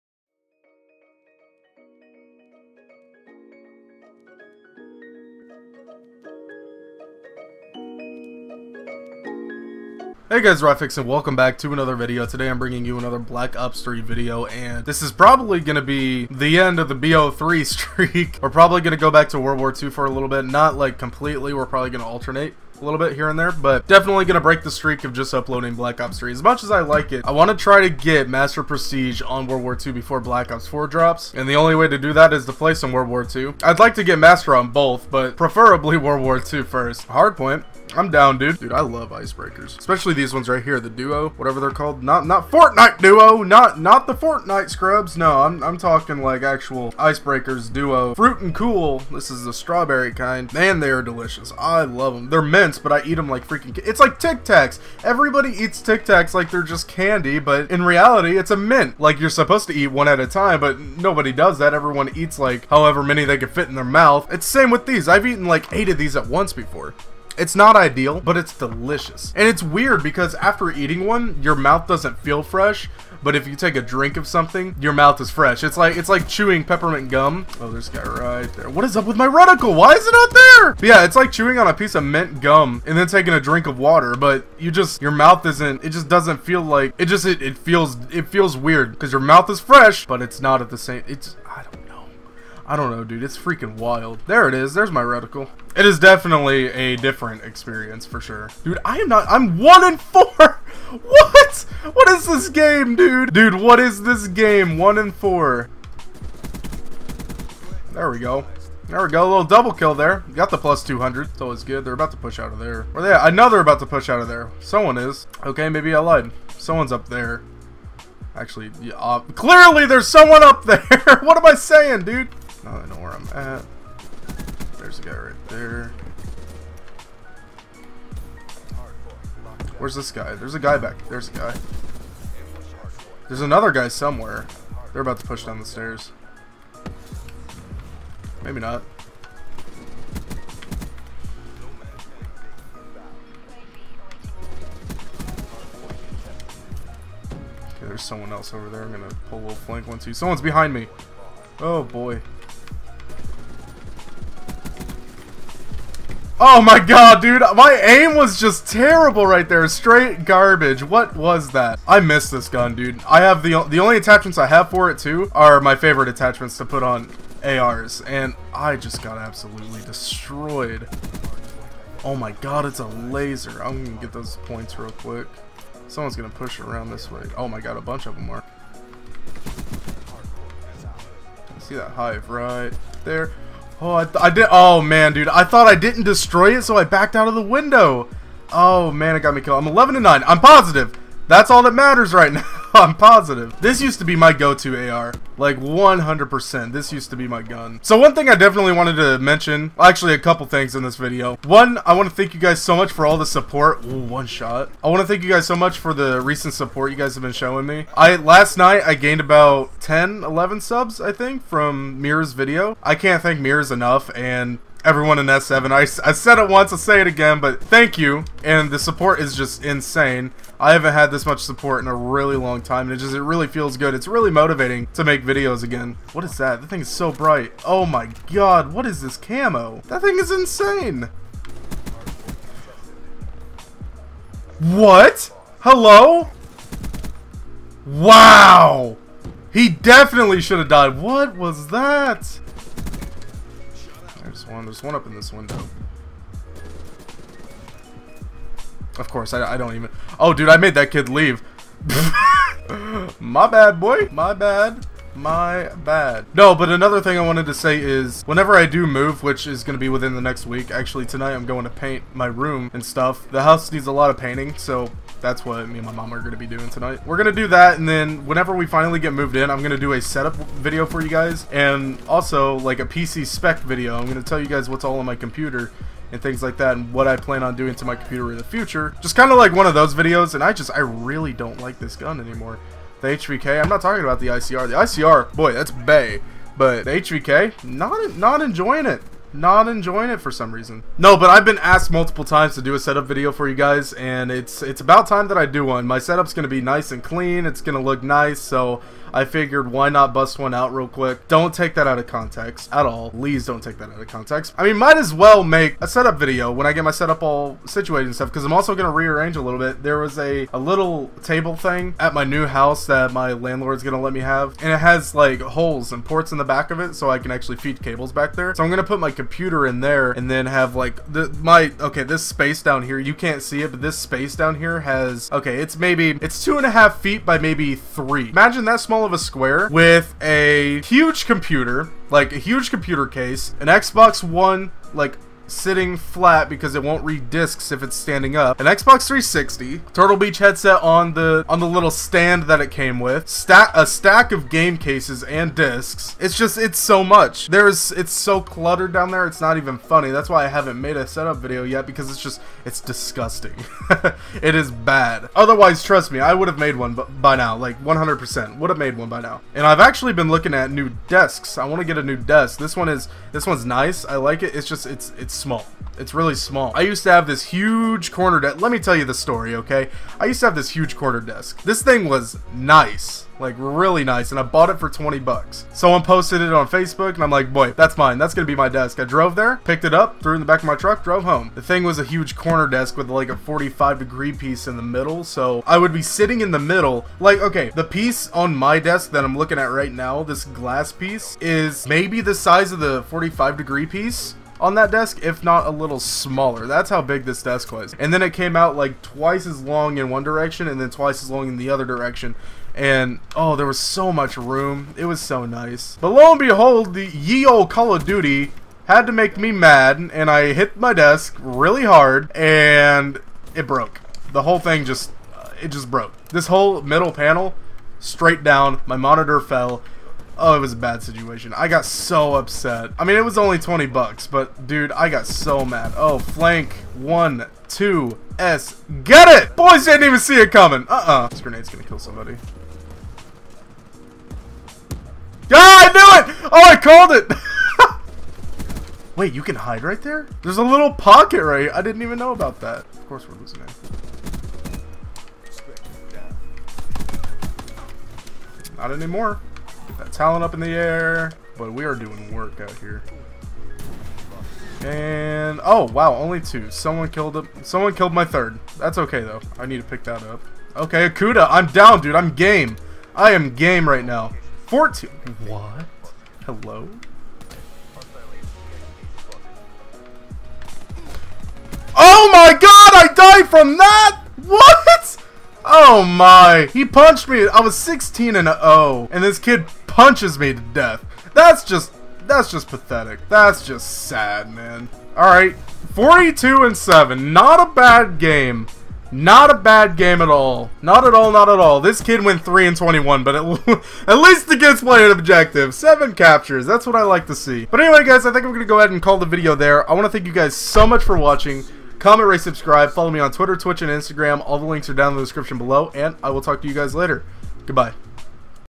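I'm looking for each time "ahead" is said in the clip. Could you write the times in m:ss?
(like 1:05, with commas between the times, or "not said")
8:18.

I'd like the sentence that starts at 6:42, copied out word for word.
And oh, there was so much room.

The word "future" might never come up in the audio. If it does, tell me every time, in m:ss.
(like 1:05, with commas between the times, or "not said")
4:38.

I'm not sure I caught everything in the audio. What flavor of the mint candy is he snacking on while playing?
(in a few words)
Strawberry.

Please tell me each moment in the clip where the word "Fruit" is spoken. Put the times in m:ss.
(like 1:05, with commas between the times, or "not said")
0:48.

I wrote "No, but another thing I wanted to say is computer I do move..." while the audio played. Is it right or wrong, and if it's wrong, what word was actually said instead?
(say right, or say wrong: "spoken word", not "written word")
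wrong: "whenever", not "computer".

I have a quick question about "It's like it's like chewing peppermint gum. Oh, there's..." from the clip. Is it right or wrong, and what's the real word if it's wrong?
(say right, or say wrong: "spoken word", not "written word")
right.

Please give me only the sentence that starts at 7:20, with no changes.
There's a little pocket right here.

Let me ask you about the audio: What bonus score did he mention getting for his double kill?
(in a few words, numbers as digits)
200.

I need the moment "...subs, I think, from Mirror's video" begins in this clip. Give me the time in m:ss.
3:30.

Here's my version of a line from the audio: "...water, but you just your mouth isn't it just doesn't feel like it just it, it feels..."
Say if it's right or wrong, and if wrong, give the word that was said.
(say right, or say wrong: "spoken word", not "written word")
right.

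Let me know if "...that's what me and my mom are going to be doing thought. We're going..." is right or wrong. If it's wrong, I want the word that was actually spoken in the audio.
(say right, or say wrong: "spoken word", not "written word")
wrong: "tonight", not "thought".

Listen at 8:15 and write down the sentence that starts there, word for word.
7 captures, that's what I like to see.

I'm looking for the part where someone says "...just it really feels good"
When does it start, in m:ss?
3:43.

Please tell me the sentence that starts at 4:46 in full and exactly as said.
But the HVK, not, not enjoying it not enjoying it for some reason.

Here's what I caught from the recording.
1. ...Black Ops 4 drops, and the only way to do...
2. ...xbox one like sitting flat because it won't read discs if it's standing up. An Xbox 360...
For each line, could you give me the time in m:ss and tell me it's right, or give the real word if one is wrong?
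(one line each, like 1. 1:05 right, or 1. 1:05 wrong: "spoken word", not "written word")
1. 0:30 right
2. 5:33 right.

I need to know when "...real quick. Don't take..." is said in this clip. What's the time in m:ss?
5:00.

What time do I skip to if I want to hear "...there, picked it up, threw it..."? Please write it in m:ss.
6:19.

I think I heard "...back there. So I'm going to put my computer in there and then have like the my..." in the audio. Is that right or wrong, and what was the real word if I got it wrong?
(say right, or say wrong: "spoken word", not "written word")
right.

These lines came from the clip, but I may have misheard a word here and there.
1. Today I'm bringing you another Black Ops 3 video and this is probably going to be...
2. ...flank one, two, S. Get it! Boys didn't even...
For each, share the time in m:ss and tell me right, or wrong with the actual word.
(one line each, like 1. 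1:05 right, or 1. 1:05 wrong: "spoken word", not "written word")
1. 0:12 right
2. 7:06 right.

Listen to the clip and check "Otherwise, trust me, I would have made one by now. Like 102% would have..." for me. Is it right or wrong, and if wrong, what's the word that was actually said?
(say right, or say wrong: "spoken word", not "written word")
wrong: "100", not "102".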